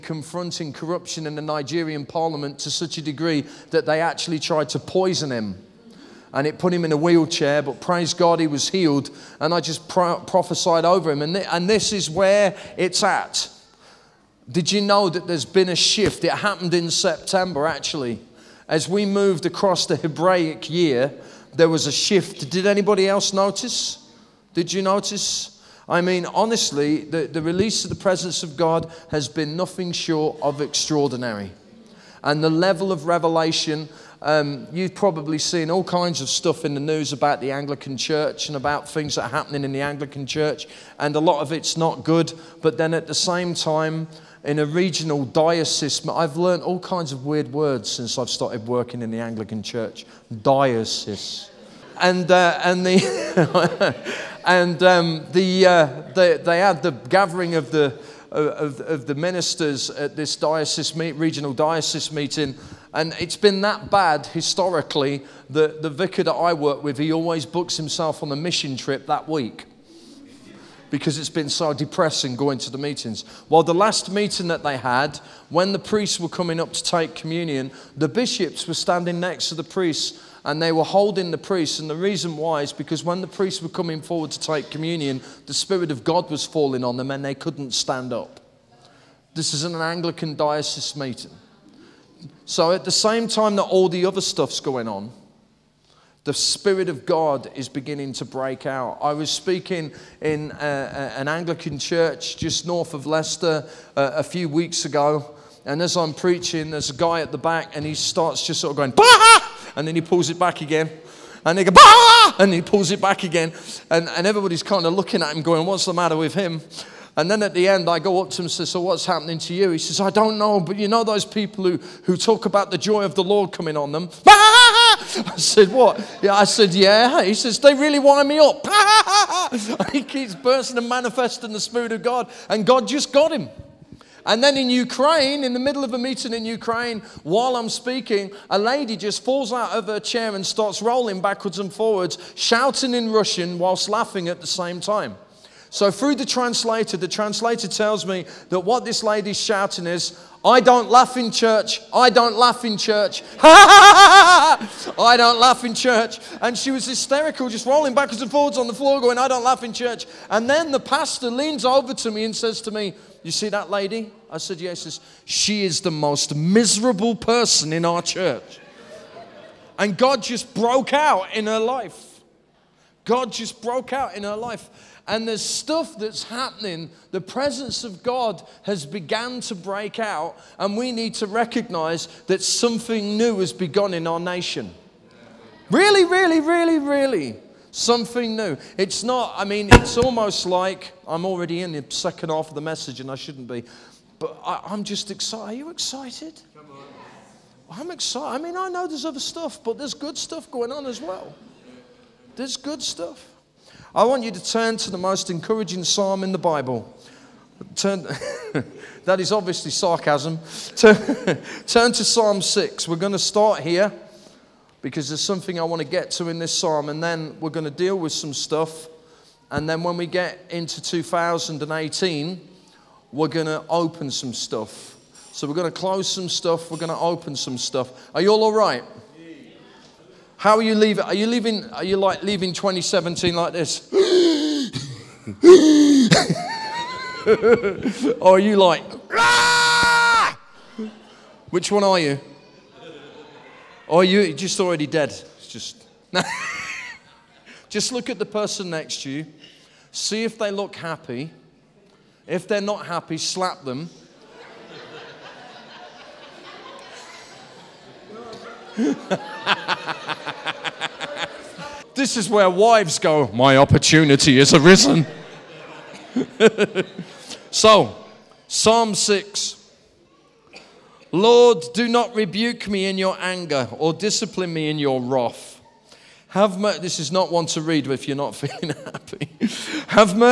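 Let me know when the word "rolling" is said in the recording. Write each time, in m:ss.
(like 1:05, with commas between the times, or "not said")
2:20, 2:37.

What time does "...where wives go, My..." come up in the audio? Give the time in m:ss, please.
4:22.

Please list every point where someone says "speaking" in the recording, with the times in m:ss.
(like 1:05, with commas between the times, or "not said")
1:39, 2:17.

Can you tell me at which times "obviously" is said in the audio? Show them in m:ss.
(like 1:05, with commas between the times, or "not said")
3:29.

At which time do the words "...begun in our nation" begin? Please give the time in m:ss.
3:03.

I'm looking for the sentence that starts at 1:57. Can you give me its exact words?
And then at the end, I go up to him and say, So, what's happening to you?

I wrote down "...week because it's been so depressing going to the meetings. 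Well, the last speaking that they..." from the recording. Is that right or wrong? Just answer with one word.
wrong.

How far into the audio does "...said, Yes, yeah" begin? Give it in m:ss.
2:44.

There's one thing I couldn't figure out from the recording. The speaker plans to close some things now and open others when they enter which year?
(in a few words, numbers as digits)
2018.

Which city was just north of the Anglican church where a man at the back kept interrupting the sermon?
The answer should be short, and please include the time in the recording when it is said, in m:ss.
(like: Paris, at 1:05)
Leicester, at 1:43.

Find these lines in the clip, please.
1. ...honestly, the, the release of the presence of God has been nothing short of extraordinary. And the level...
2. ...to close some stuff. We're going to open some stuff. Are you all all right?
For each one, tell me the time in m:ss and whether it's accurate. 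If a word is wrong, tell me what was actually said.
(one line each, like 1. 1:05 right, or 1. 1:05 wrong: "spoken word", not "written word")
1. 0:26 right
2. 3:45 right.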